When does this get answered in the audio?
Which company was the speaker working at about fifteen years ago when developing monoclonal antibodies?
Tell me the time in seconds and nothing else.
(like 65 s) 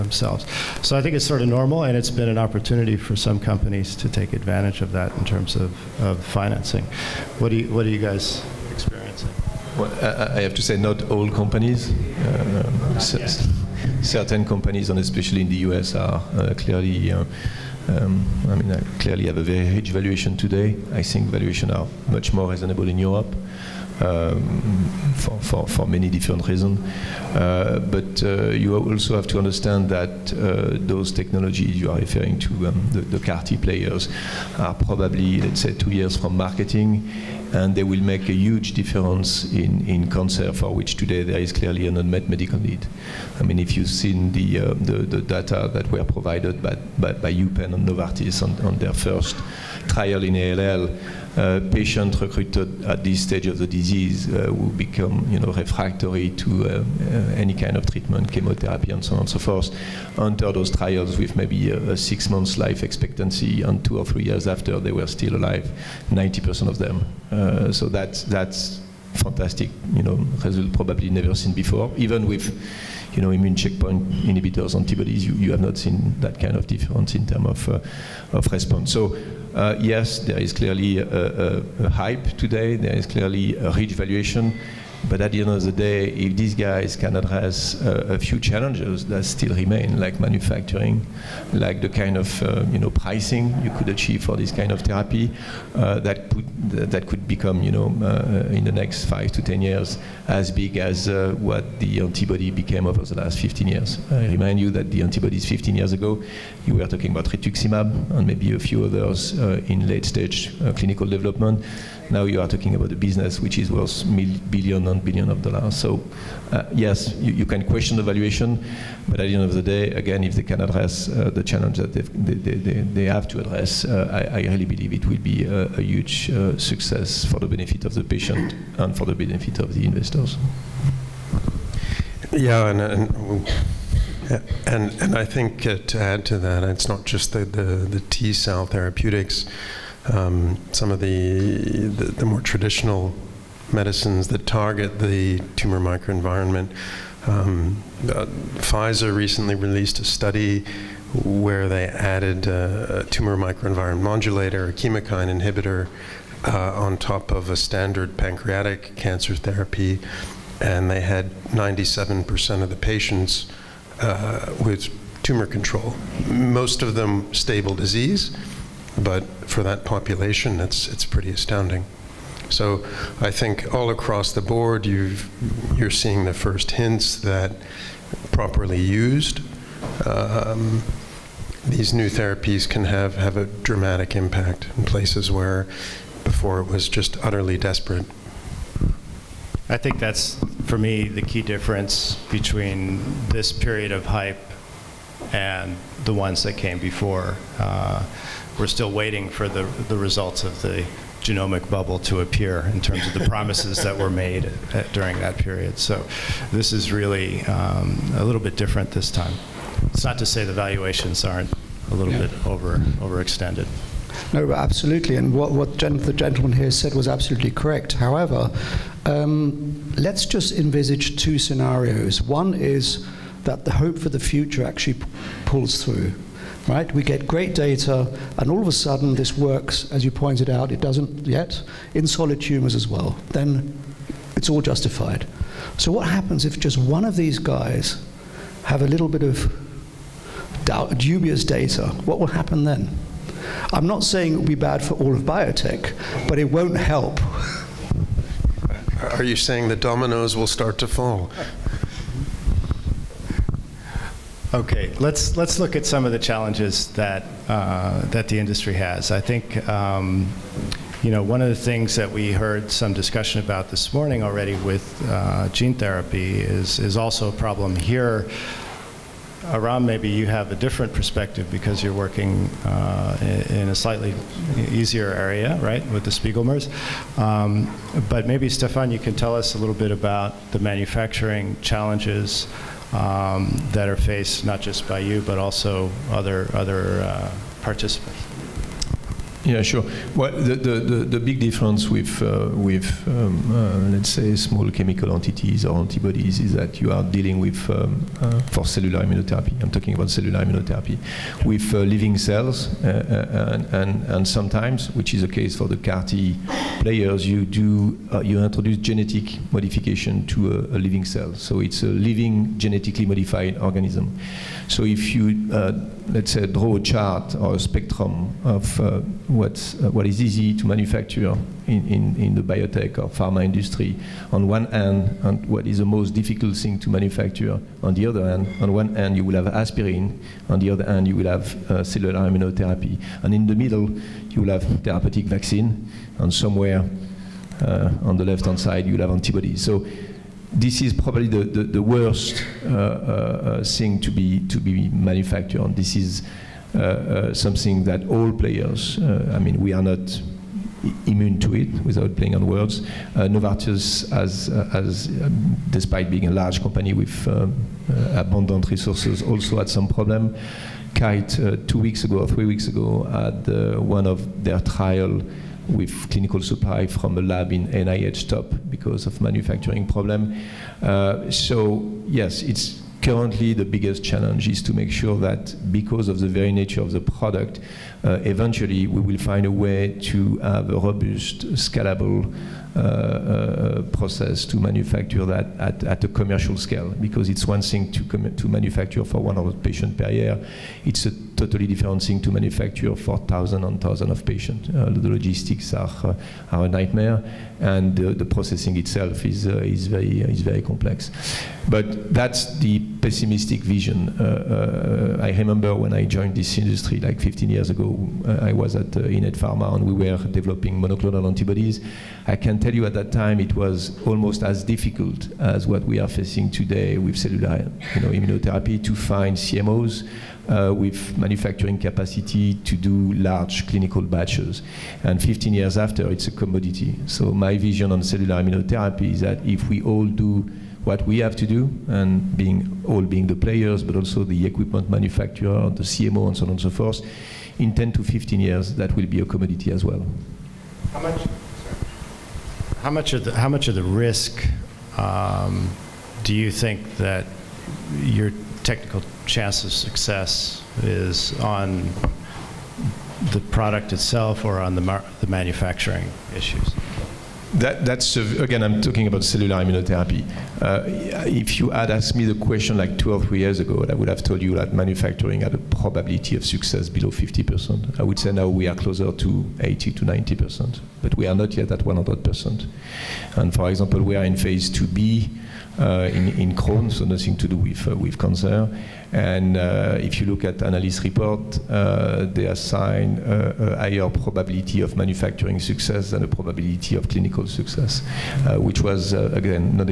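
409 s.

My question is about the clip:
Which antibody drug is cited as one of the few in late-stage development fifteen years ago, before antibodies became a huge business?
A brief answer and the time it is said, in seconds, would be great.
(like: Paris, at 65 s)
rituximab, at 107 s.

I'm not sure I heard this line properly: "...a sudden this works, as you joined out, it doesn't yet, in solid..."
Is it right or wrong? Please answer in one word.
wrong.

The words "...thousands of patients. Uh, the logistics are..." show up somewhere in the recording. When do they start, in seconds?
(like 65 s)
393 s.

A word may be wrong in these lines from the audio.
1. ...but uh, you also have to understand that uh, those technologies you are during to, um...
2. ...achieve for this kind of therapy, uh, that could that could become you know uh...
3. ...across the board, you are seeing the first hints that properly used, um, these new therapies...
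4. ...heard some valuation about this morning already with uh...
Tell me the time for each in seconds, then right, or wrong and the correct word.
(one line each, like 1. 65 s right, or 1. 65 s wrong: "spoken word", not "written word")
1. 27 s wrong: "referring", not "during"
2. 93 s right
3. 173 s right
4. 262 s wrong: "discussion", not "valuation".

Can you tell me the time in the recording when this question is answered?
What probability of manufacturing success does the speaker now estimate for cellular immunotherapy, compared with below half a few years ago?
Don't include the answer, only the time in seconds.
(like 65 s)
469 s.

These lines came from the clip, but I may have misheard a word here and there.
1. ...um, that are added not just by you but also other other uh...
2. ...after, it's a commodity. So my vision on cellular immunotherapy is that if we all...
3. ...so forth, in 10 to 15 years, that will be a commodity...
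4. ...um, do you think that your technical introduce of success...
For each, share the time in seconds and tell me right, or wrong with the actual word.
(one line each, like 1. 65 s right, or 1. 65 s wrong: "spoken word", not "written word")
1. 282 s wrong: "faced", not "added"
2. 425 s right
3. 436 s right
4. 444 s wrong: "chance", not "introduce".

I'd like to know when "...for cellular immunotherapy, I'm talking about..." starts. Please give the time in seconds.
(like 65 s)
298 s.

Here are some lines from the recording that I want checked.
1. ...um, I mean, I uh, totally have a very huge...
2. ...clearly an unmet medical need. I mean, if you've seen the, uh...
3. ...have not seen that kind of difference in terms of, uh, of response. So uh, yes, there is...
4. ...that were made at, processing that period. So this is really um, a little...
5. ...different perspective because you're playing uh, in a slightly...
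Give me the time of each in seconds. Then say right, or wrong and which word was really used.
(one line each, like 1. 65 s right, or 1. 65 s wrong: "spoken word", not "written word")
1. 17 s wrong: "clearly", not "totally"
2. 41 s right
3. 75 s right
4. 203 s wrong: "during", not "processing"
5. 270 s wrong: "working", not "playing".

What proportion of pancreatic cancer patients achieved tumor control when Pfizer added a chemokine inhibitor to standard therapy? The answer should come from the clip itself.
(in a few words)
97%.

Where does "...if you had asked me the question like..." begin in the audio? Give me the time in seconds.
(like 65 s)
461 s.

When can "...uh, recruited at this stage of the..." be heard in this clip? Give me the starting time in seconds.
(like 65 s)
51 s.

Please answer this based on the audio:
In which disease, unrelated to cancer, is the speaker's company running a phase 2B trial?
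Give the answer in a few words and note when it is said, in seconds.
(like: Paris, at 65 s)
Crohn's, at 476 s.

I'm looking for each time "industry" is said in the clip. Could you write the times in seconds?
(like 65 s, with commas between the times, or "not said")
258 s, 323 s, 406 s.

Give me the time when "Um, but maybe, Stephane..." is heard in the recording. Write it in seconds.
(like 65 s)
277 s.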